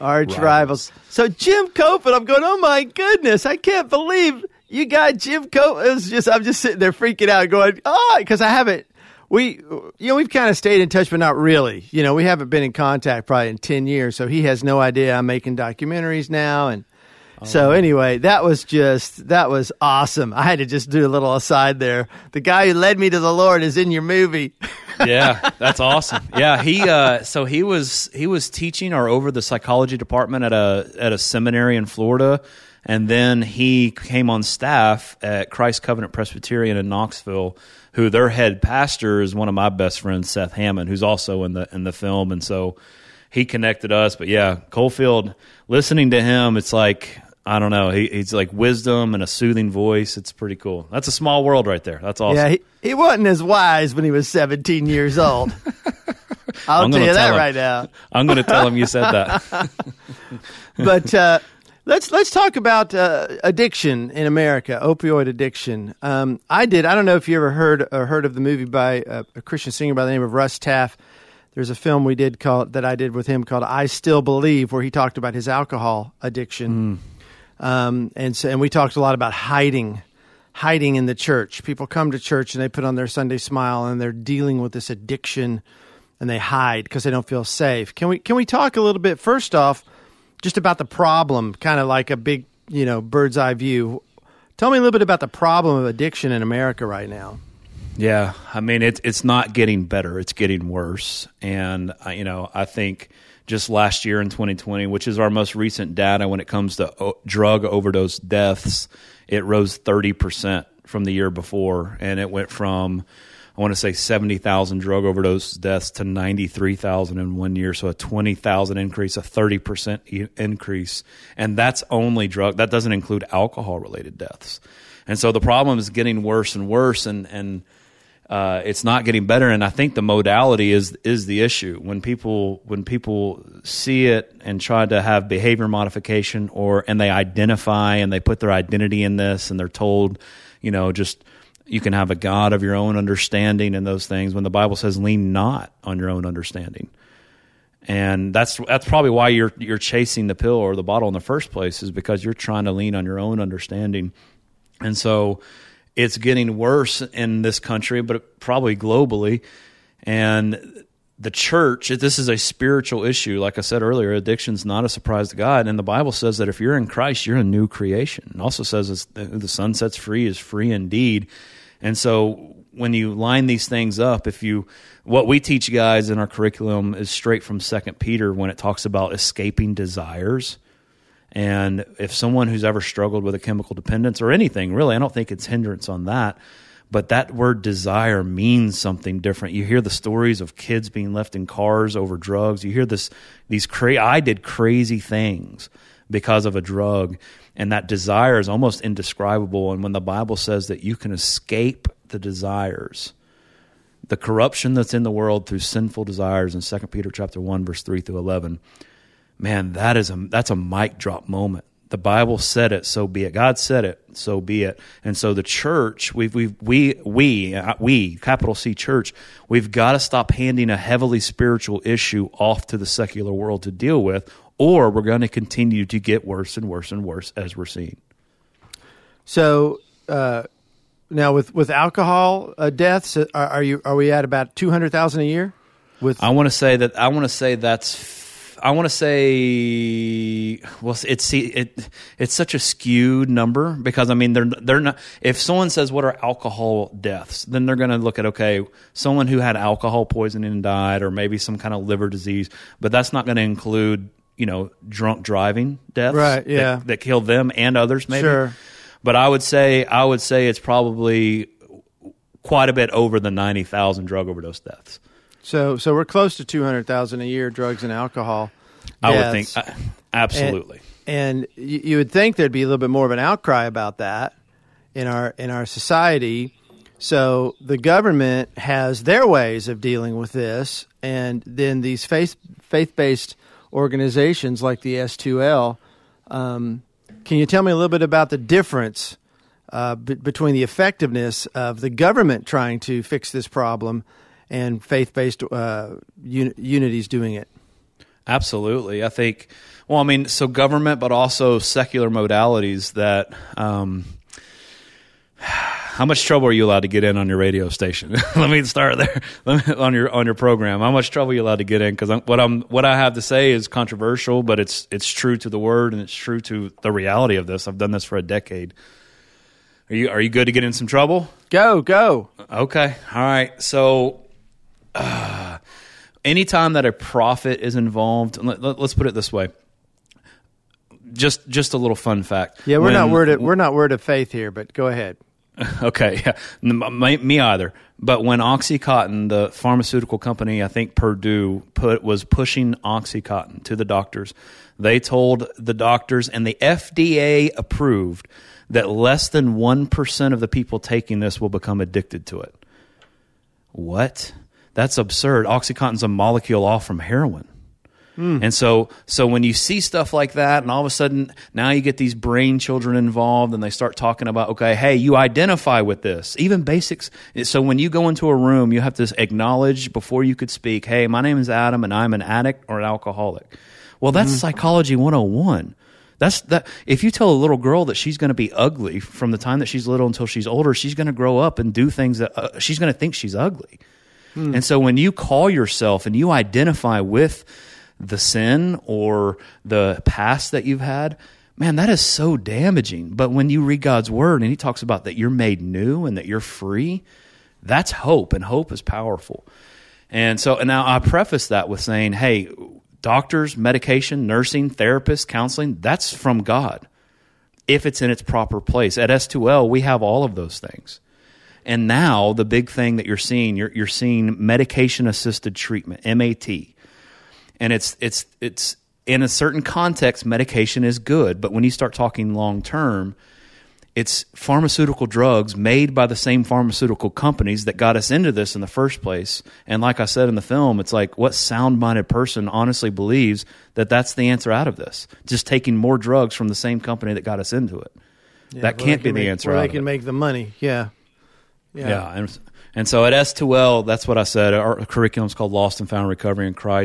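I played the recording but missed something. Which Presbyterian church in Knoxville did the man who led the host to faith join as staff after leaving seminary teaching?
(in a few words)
Christ Covenant Presbyterian.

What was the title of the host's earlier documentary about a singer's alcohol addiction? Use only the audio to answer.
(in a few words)
I Still Believe.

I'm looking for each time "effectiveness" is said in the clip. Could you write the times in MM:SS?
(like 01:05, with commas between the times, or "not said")
04:50.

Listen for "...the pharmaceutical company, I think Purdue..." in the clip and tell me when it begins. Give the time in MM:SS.
05:39.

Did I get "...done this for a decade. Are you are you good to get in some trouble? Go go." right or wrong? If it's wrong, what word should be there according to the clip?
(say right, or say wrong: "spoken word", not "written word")
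right.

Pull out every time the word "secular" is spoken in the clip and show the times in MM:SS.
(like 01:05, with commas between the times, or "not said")
03:42, 05:01.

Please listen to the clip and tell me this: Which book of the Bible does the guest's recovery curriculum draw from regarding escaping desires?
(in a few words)
Second Peter.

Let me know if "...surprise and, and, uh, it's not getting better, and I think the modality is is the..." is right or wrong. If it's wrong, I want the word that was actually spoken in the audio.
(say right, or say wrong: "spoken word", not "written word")
wrong: "worse", not "surprise".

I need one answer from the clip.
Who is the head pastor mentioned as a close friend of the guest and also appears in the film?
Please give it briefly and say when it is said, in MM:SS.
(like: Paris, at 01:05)
Seth Hammond, at 00:40.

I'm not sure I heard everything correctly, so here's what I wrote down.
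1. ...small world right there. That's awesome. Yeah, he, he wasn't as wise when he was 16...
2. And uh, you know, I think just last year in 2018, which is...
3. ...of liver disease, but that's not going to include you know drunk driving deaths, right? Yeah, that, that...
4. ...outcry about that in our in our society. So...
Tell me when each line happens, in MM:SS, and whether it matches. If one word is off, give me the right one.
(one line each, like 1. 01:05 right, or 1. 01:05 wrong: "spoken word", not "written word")
1. 00:51 wrong: "17", not "16"
2. 01:41 wrong: "2020", not "2018"
3. 04:11 right
4. 04:33 right.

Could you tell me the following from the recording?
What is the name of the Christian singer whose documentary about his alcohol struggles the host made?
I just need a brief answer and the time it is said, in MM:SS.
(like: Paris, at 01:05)
Russ Taff, at 01:10.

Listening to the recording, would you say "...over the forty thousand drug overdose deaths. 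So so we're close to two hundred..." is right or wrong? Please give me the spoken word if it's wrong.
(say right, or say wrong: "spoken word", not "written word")
wrong: "ninety", not "forty".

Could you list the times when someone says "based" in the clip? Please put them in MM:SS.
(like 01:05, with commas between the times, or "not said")
04:42, 04:55.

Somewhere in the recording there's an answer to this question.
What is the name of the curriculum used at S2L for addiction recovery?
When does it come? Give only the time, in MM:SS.
07:25.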